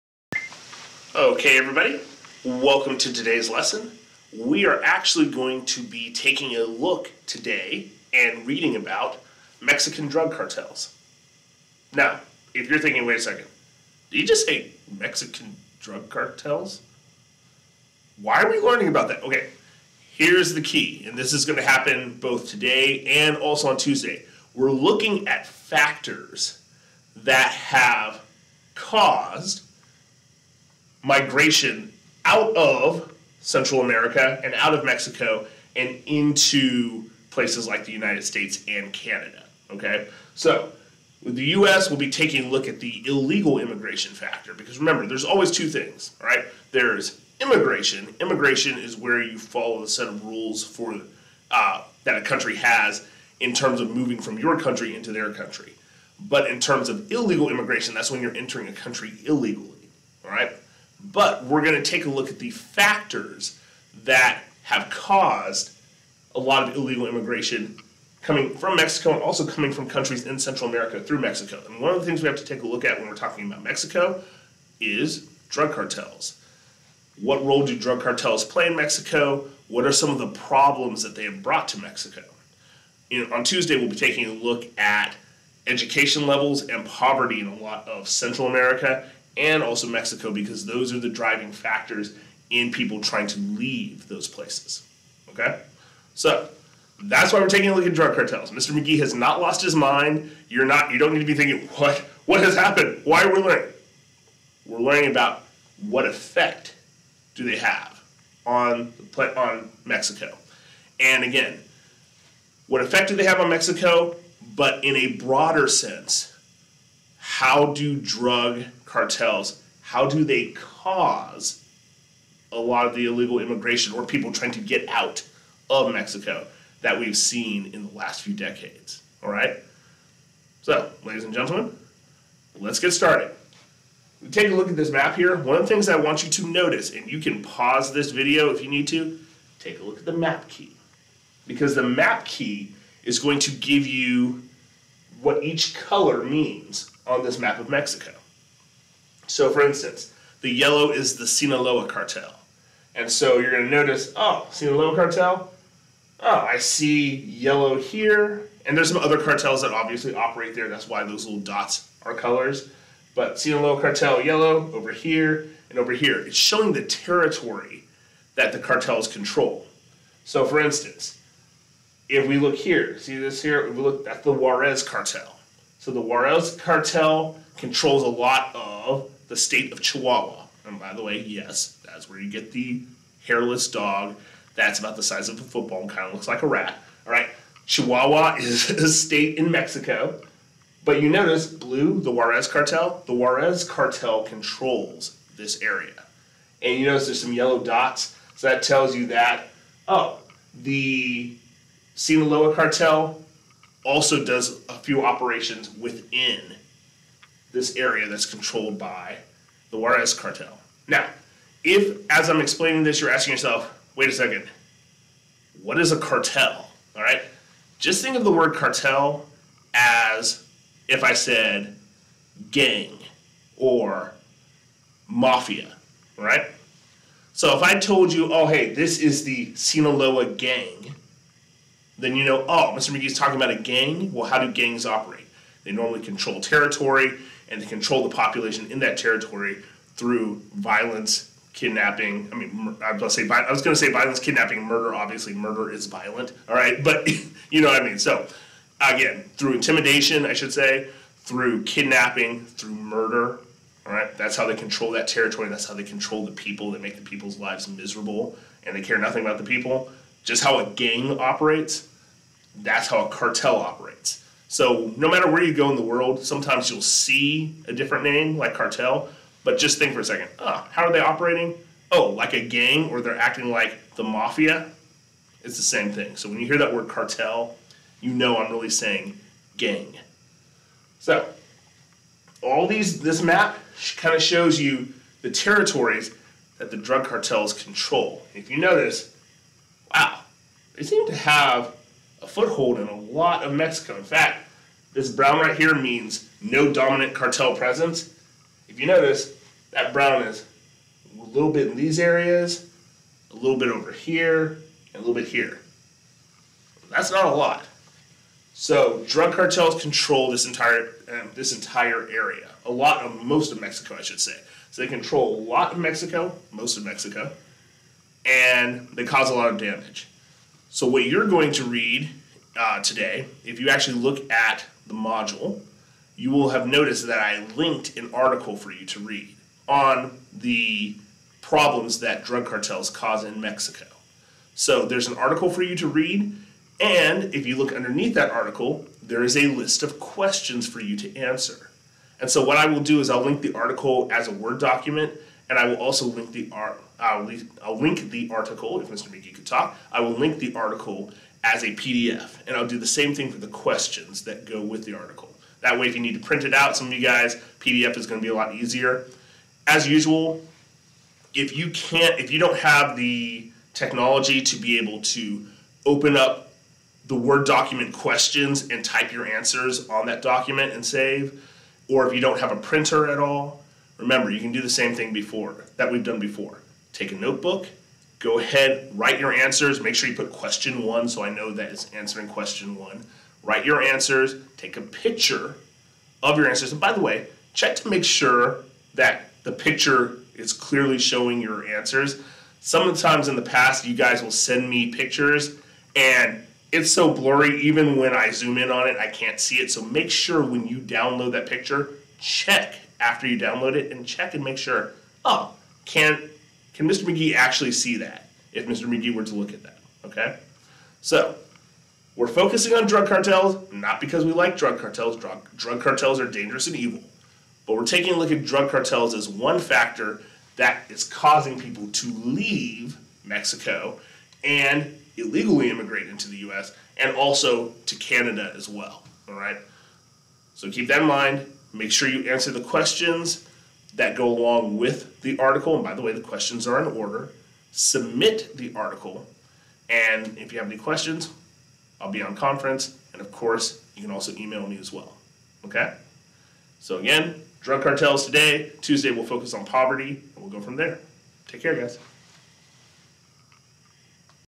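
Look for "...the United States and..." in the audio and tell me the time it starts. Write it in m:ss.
0:37.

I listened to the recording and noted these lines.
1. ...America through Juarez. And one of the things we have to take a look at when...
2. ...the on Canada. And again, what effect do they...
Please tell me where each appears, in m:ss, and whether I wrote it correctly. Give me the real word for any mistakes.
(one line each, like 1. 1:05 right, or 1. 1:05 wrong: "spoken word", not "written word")
1. 1:10 wrong: "Mexico", not "Juarez"
2. 1:49 wrong: "Mexico", not "Canada".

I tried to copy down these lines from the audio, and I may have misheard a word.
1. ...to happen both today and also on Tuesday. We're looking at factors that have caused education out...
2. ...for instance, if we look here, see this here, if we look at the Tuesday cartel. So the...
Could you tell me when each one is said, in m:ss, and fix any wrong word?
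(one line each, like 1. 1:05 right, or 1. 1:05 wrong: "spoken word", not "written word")
1. 0:21 wrong: "migration", not "education"
2. 2:50 wrong: "Juarez", not "Tuesday".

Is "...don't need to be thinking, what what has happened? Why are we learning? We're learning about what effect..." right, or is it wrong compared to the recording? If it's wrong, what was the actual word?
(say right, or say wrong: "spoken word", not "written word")
right.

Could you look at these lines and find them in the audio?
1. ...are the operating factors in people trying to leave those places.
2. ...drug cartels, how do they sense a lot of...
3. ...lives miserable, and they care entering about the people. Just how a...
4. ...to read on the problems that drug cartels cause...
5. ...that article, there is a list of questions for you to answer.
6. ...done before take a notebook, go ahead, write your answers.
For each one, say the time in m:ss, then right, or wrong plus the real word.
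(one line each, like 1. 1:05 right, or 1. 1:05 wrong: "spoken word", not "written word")
1. 1:30 wrong: "driving", not "operating"
2. 1:57 wrong: "cause", not "sense"
3. 4:17 wrong: "nothing", not "entering"
4. 5:28 right
5. 5:38 right
6. 6:16 right.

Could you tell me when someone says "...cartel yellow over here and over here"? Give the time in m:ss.
2:43.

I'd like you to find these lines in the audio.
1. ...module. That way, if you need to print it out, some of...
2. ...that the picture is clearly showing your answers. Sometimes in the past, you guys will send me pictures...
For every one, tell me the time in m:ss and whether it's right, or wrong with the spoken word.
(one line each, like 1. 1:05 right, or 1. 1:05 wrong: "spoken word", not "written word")
1. 5:54 wrong: "article", not "module"
2. 6:28 right.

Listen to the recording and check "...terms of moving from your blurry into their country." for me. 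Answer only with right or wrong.
wrong.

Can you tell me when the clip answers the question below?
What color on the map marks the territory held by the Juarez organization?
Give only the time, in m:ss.
3:11.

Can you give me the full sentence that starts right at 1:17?
What role do drug cartels play in Mexico?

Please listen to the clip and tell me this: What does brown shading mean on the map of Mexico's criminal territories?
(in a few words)
No dominant cartel presence.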